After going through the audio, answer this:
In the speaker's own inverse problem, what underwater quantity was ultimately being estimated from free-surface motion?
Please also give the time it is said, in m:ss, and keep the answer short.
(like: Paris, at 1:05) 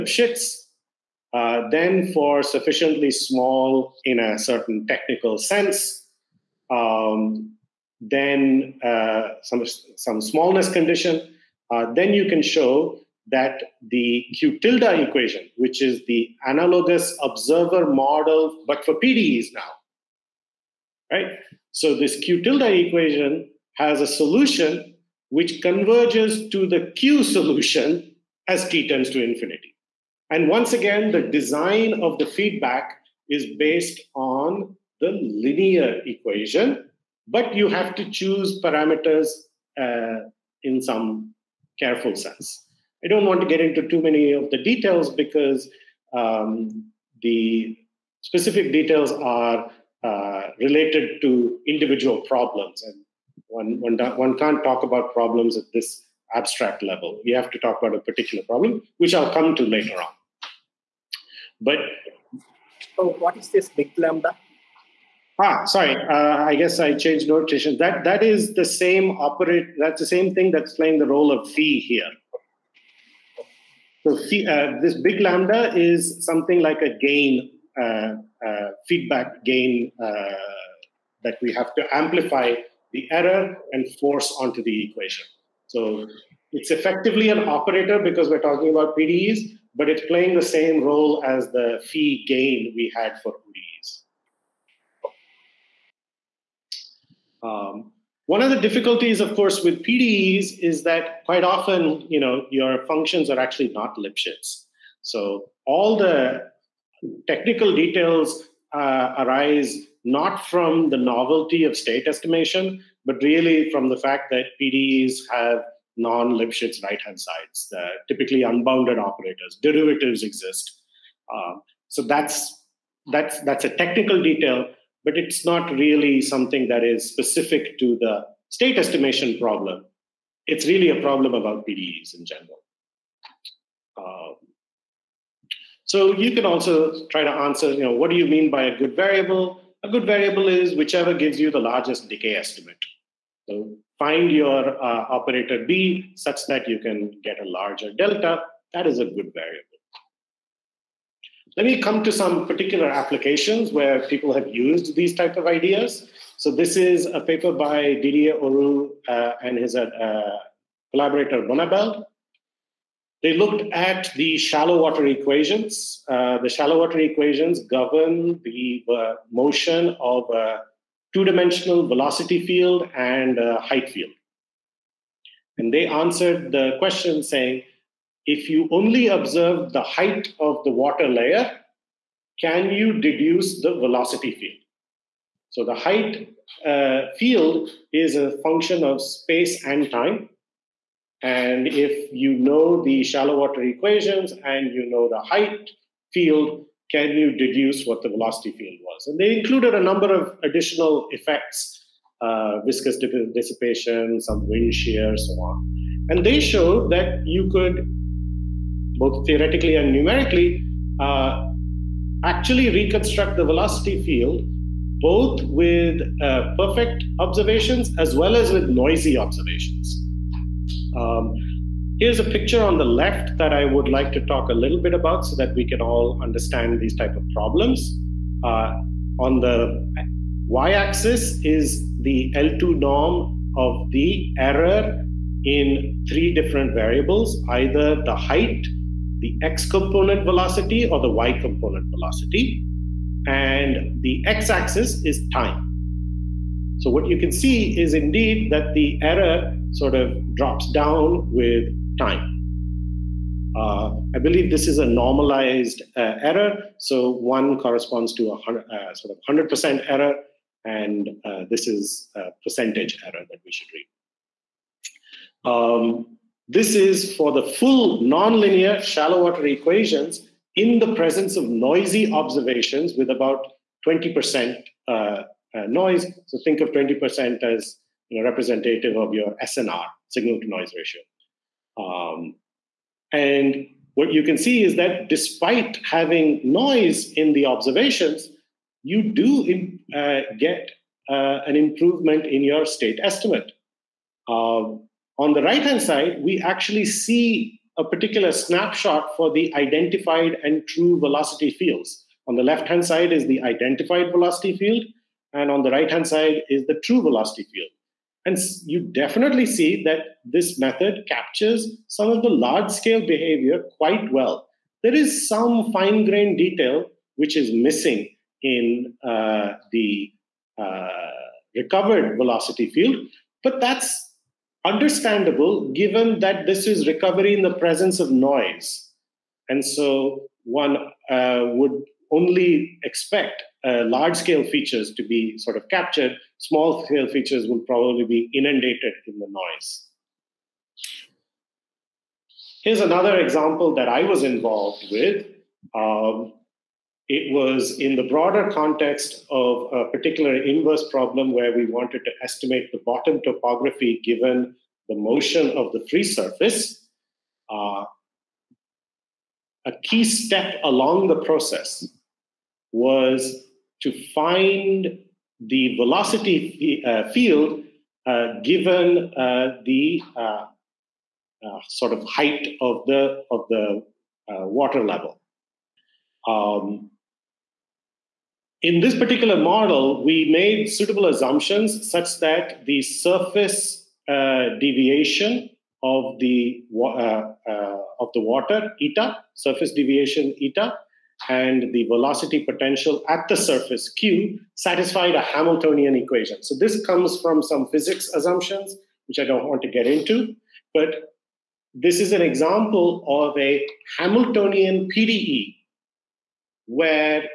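bottom topography, at 5:52.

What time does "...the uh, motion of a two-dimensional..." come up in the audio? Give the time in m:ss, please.
2:48.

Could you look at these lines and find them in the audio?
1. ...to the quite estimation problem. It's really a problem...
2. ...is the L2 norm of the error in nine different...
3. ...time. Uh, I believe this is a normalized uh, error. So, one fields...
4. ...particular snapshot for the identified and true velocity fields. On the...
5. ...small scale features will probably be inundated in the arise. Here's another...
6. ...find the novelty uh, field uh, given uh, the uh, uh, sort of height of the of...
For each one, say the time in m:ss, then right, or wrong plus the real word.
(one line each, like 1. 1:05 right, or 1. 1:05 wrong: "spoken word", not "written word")
1. 2:07 wrong: "state", not "quite"
2. 3:51 wrong: "three", not "nine"
3. 4:11 wrong: "corresponds", not "fields"
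4. 4:57 right
5. 5:36 wrong: "noise", not "arise"
6. 6:04 wrong: "velocity", not "novelty".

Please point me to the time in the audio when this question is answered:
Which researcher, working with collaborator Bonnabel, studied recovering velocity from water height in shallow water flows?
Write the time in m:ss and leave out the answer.
2:38.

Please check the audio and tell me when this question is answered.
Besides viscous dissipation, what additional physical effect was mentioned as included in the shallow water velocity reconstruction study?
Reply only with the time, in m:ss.
3:24.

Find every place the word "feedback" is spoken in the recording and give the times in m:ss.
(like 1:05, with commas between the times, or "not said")
0:32, 1:18.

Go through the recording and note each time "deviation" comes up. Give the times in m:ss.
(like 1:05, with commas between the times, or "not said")
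6:24, 6:29.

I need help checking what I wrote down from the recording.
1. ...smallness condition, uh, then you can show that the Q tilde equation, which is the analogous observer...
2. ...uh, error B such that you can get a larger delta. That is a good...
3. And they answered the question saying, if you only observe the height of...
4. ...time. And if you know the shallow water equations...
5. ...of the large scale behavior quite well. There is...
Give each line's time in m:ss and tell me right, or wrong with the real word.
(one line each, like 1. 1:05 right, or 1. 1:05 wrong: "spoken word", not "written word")
1. 0:10 right
2. 2:24 wrong: "operator", not "error"
3. 2:55 right
4. 3:09 right
5. 5:12 right.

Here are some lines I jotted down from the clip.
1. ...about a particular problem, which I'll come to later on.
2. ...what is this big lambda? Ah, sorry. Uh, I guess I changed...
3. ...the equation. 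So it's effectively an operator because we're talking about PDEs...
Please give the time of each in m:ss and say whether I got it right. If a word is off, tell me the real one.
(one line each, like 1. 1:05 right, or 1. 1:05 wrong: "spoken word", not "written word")
1. 0:57 right
2. 1:03 right
3. 1:24 right.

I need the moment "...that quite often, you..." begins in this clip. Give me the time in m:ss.
1:40.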